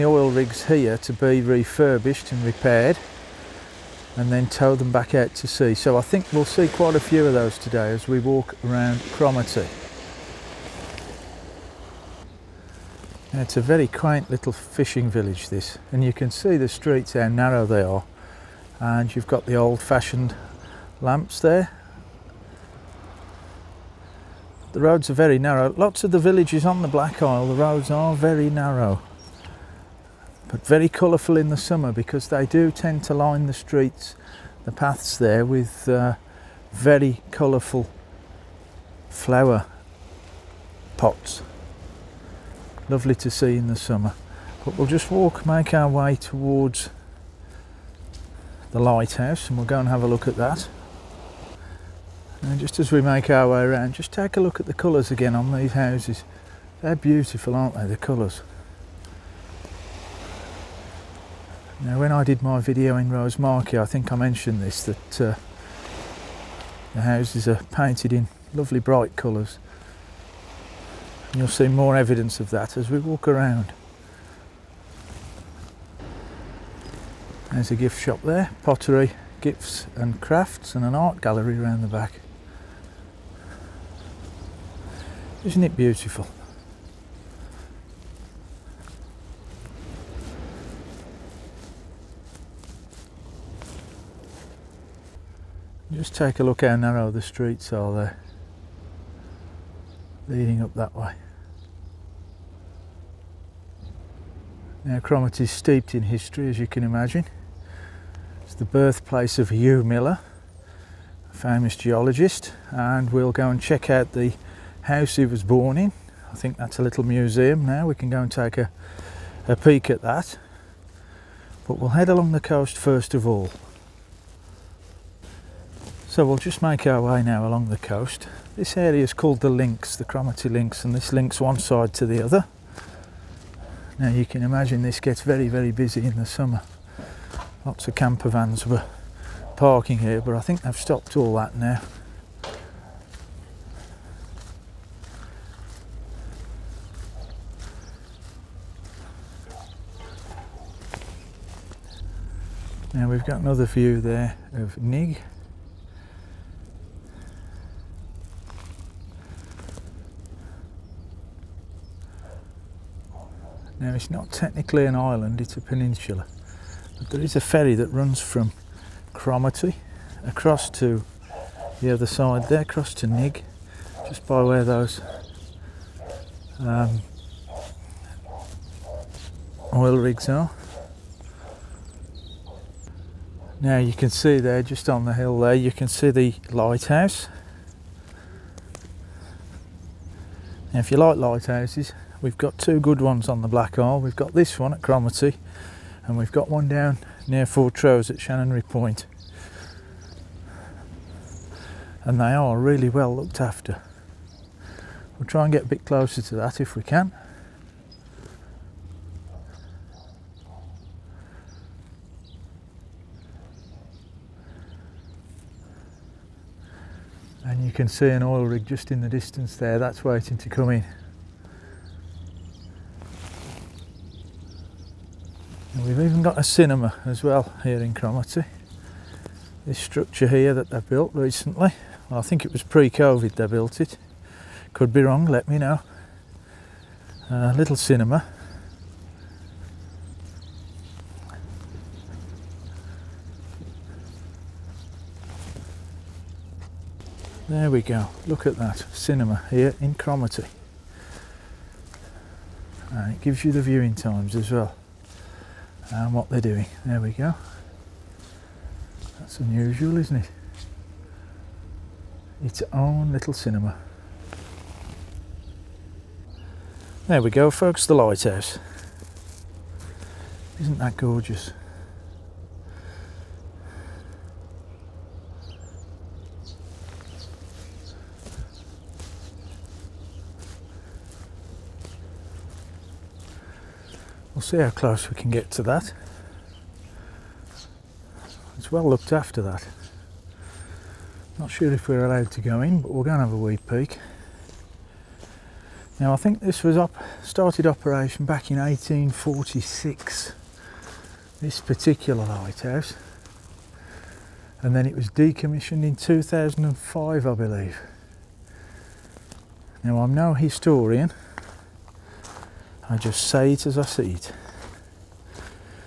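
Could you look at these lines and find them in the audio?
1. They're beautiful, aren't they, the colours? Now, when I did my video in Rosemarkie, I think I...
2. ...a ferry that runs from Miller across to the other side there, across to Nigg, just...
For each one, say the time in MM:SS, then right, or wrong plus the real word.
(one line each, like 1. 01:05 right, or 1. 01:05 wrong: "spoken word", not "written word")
1. 00:56 right
2. 02:47 wrong: "Cromarty", not "Miller".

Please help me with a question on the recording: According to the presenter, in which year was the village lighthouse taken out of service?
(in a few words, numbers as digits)
2005.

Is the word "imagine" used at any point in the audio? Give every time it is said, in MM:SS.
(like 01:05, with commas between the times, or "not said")
01:46, 02:14.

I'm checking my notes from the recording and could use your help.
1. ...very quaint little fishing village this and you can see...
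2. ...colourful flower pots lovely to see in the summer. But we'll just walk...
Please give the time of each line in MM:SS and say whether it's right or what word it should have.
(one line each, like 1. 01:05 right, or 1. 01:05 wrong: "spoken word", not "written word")
1. 00:13 right
2. 00:37 right.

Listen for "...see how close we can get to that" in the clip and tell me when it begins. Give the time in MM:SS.
04:44.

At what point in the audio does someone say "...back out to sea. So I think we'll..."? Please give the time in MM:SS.
00:04.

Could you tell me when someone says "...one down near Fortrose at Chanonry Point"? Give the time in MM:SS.
03:16.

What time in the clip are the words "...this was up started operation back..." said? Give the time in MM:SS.
04:56.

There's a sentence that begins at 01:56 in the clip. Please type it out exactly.
I think that's a little museum now, we can go and take a, a peek at that.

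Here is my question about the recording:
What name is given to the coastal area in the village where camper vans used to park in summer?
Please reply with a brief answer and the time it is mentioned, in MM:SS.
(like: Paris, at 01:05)
the Cromarty links, at 02:09.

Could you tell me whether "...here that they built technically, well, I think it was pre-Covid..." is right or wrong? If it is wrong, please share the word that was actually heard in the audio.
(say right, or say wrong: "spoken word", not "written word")
wrong: "recently", not "technically".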